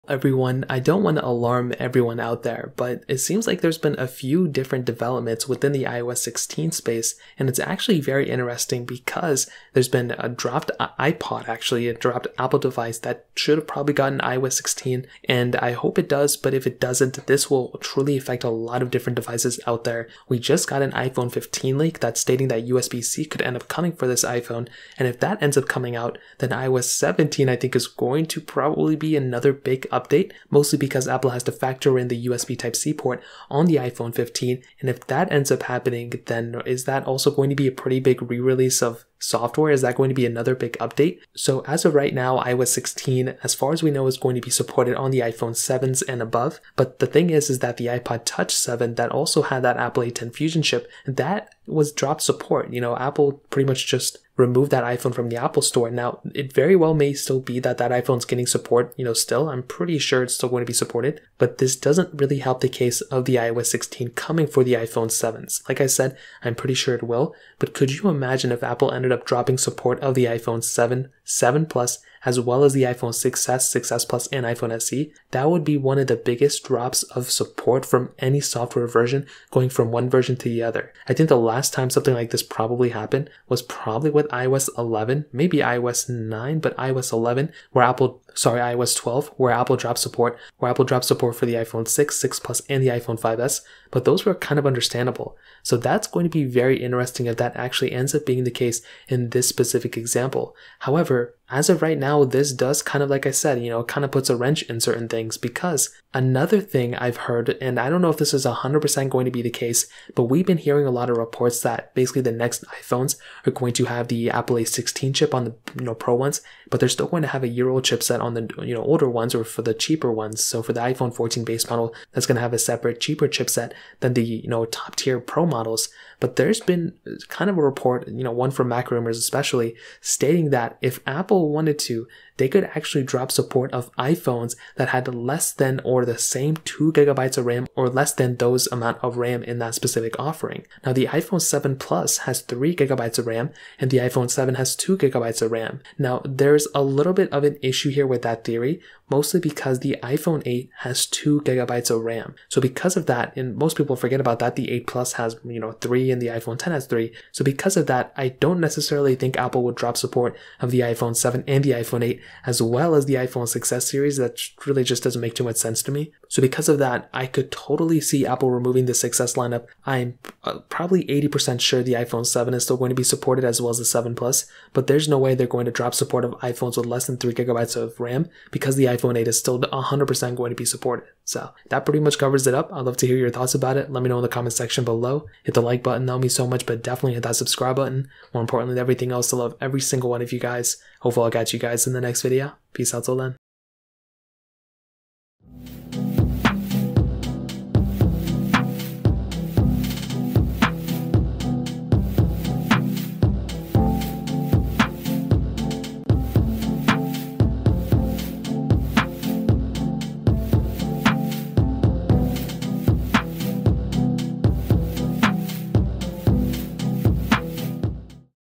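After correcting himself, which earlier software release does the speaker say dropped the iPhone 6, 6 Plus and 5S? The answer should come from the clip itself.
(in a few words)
iOS 12.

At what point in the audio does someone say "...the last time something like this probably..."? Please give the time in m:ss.
1:21.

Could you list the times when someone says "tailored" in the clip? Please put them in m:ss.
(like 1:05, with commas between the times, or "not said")
not said.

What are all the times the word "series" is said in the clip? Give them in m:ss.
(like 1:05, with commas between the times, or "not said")
2:43.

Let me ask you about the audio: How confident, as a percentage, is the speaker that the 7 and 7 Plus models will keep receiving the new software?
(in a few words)
80%.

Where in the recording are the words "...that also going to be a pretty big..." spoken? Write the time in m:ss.
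0:36.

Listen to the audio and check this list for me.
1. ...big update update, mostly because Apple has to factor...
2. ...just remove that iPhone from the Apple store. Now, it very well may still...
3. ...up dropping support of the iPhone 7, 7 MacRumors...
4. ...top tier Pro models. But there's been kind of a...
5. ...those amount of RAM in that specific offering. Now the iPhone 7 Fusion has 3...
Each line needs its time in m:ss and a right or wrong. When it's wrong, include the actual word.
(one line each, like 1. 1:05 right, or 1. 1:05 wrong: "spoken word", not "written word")
1. 0:29 right
2. 0:53 right
3. 1:09 wrong: "Plus", not "MacRumors"
4. 2:04 right
5. 2:18 wrong: "Plus", not "Fusion".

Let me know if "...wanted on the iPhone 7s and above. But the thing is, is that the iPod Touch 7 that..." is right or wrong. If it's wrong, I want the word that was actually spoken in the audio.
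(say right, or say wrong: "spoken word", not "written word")
wrong: "supported", not "wanted".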